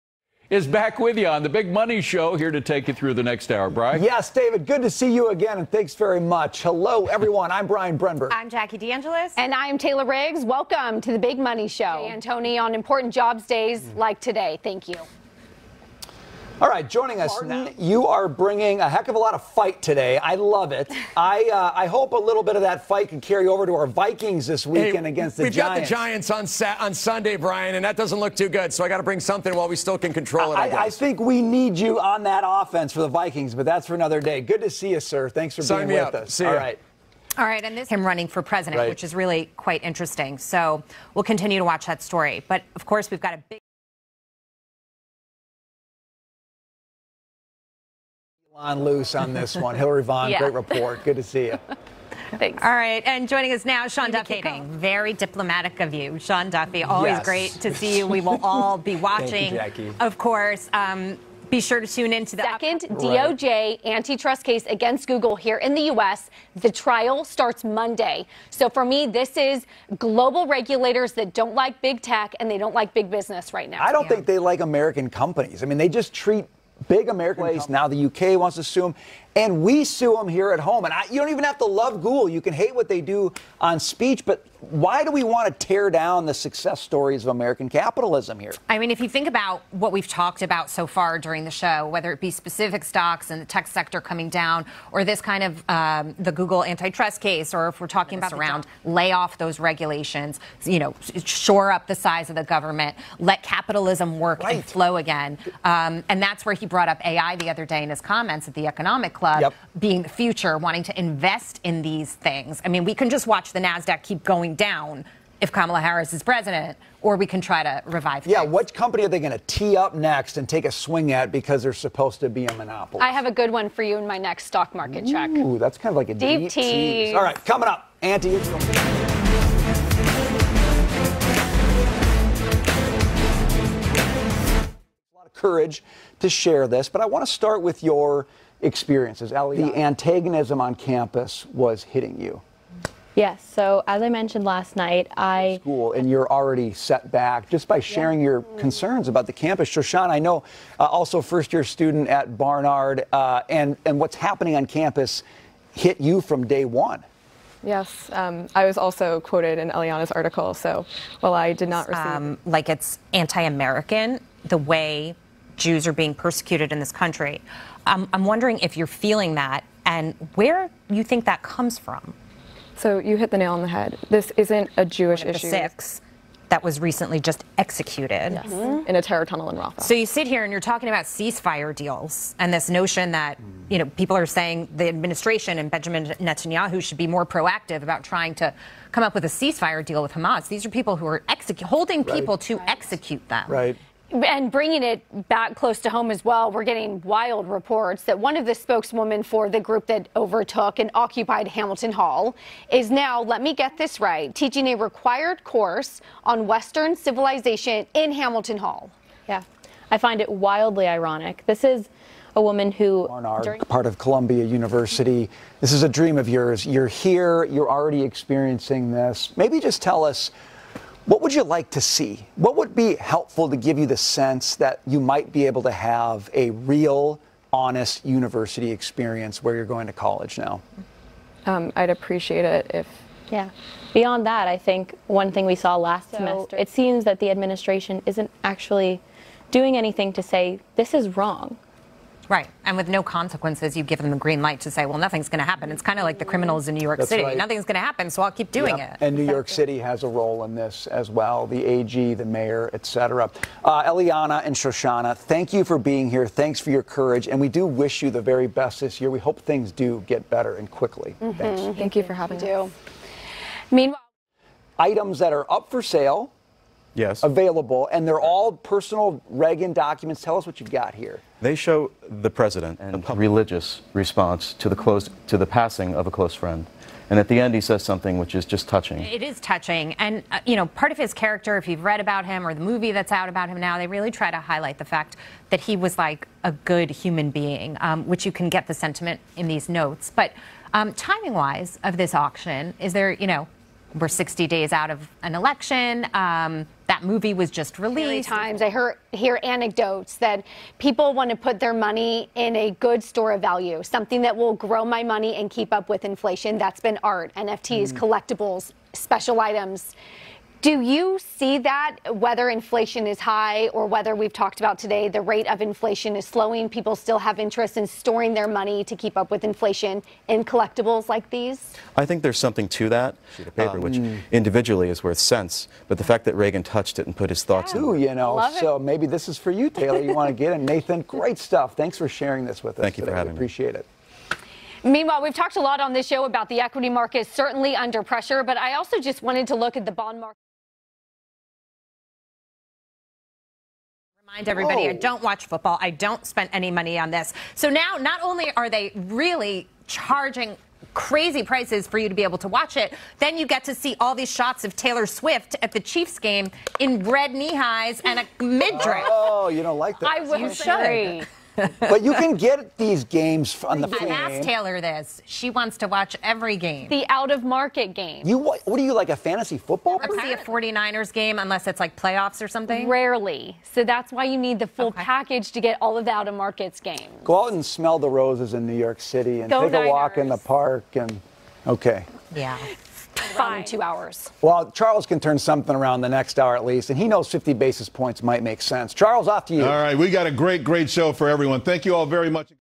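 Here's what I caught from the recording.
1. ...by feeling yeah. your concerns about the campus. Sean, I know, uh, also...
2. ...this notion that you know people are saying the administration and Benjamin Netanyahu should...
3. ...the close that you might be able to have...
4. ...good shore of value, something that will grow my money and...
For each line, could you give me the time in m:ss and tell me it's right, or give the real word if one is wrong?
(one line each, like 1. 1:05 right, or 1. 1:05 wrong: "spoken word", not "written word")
1. 2:27 wrong: "sharing", not "feeling"
2. 3:02 right
3. 3:43 wrong: "sense", not "close"
4. 5:02 wrong: "store", not "shore".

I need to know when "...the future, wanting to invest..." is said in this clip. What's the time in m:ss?
1:50.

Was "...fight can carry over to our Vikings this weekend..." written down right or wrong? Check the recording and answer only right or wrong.
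right.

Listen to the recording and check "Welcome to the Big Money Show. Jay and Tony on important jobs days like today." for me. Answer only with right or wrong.
right.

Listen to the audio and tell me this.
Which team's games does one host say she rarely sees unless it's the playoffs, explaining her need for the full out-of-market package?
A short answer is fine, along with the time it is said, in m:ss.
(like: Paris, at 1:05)
49ers, at 6:09.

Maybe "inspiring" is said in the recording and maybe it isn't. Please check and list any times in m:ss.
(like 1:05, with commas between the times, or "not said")
not said.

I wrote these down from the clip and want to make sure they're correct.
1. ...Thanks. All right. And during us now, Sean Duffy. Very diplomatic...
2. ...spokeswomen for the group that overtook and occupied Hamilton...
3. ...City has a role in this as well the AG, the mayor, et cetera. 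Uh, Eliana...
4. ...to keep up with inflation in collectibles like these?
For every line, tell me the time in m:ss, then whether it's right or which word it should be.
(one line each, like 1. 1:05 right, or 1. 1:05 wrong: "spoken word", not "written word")
1. 0:52 wrong: "joining", not "during"
2. 3:18 right
3. 4:09 right
4. 5:18 right.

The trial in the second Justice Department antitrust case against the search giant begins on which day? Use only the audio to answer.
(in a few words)
Monday.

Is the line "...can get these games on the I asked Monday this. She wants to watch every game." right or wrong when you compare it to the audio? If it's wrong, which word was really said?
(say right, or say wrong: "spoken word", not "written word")
wrong: "Taylor", not "Monday".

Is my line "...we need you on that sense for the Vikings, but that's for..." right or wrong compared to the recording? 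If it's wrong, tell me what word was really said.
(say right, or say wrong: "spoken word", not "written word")
wrong: "offense", not "sense".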